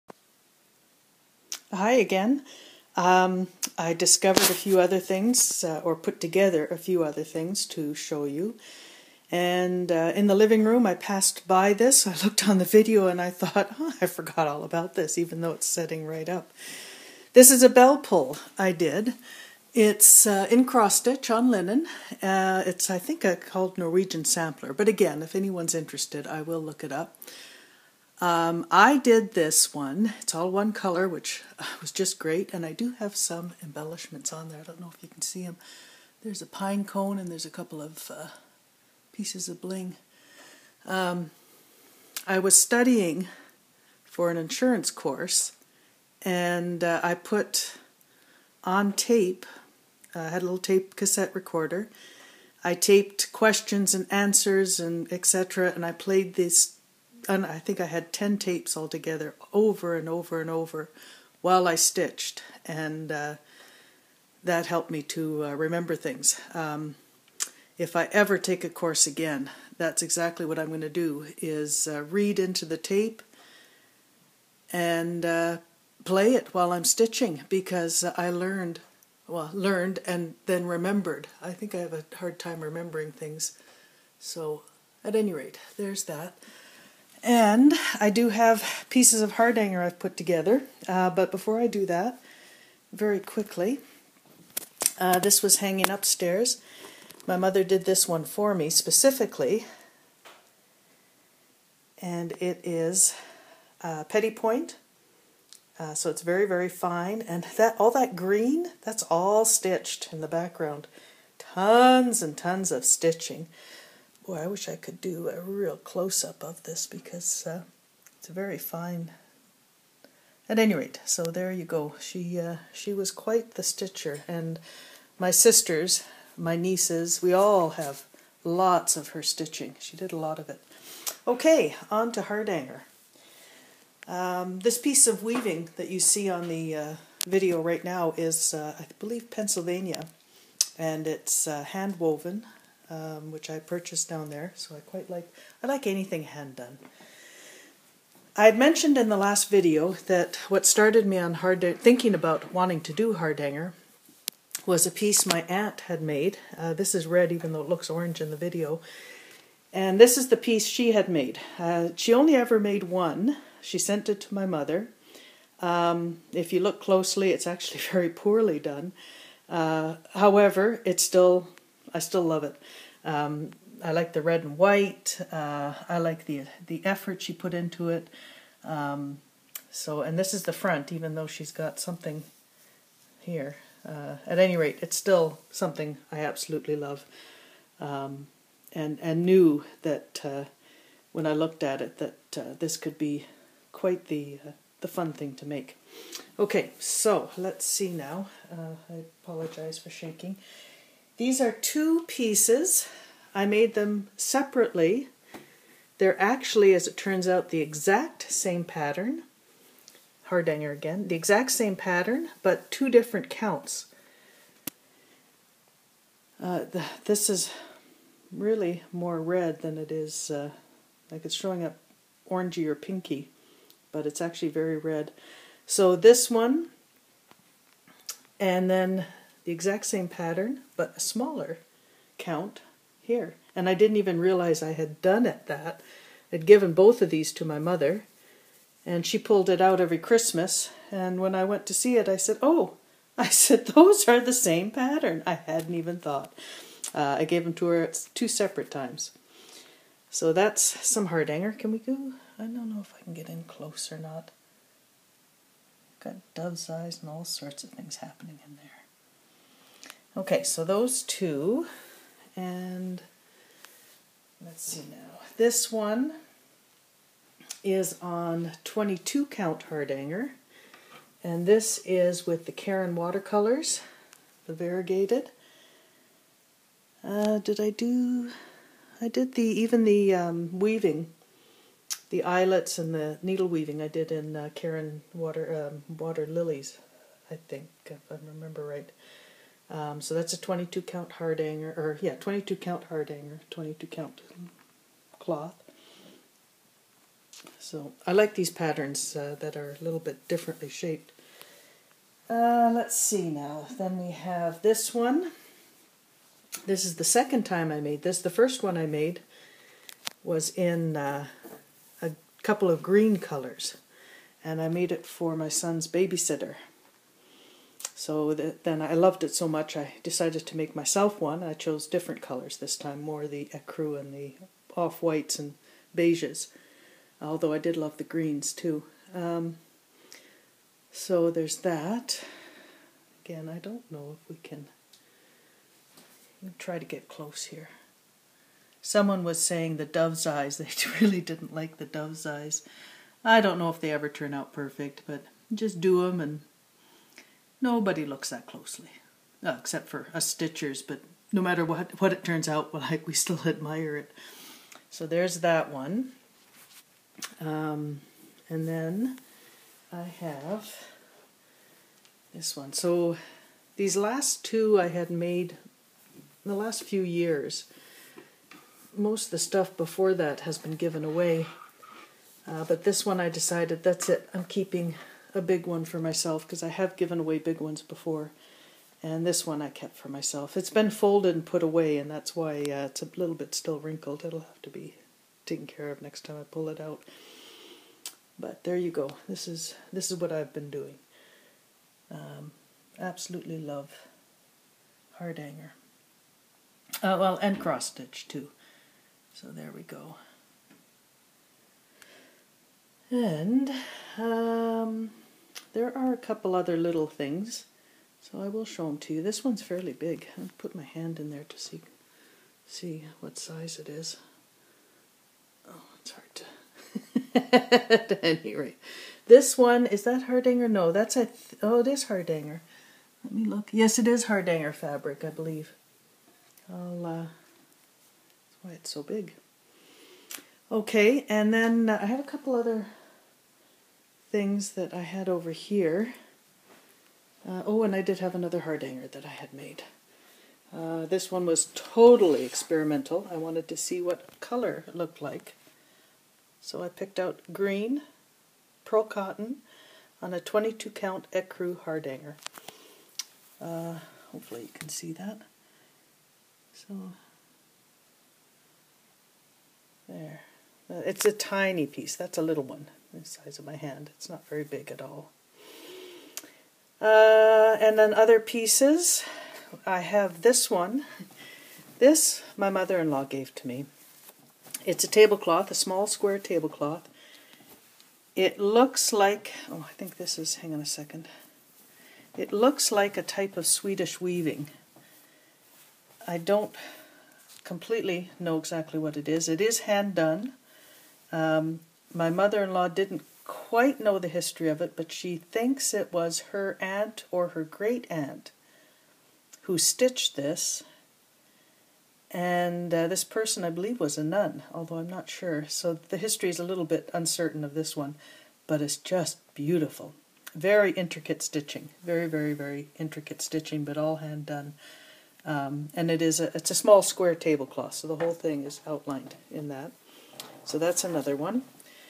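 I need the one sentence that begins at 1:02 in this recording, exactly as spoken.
And uh, that helped me to uh, remember things.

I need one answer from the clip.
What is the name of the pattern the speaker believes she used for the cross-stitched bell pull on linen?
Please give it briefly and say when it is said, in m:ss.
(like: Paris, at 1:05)
Norwegian Sampler, at 0:23.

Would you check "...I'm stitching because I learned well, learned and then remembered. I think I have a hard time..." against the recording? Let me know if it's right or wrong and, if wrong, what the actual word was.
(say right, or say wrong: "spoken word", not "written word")
right.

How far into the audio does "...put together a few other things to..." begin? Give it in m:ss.
0:05.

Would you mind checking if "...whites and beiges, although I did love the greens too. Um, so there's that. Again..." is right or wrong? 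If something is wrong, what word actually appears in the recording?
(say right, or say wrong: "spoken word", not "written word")
right.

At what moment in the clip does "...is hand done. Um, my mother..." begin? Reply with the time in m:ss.
8:09.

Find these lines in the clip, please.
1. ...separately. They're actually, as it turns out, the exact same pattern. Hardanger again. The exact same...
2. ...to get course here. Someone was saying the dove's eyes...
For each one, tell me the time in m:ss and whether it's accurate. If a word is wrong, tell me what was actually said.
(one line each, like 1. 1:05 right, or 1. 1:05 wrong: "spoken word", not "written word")
1. 3:24 right
2. 5:36 wrong: "close", not "course".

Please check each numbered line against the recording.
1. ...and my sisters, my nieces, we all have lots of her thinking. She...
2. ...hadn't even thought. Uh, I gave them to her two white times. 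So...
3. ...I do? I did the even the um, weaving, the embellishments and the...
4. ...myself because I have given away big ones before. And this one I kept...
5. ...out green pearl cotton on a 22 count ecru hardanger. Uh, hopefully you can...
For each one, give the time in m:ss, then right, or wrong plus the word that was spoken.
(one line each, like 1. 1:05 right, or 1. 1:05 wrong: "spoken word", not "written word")
1. 2:04 wrong: "stitching", not "thinking"
2. 4:05 wrong: "separate", not "white"
3. 4:37 wrong: "eyelets", not "embellishments"
4. 6:15 right
5. 7:27 right.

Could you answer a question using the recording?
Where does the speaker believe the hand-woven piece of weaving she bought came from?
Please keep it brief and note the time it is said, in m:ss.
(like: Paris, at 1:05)
Pennsylvania, at 2:19.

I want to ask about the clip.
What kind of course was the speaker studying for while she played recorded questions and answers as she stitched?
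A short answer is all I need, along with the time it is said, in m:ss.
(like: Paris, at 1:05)
insurance course, at 0:44.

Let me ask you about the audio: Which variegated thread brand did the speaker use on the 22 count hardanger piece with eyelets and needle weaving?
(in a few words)
Caron watercolors.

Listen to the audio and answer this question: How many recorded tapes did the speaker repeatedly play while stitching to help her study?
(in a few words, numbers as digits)
10.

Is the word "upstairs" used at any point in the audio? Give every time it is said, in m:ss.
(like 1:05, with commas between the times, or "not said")
1:35.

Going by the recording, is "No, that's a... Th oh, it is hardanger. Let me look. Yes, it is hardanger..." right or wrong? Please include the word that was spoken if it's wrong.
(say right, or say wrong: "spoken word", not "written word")
right.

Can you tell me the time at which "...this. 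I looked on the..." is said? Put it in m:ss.
0:11.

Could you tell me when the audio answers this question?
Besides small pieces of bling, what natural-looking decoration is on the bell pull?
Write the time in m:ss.
0:36.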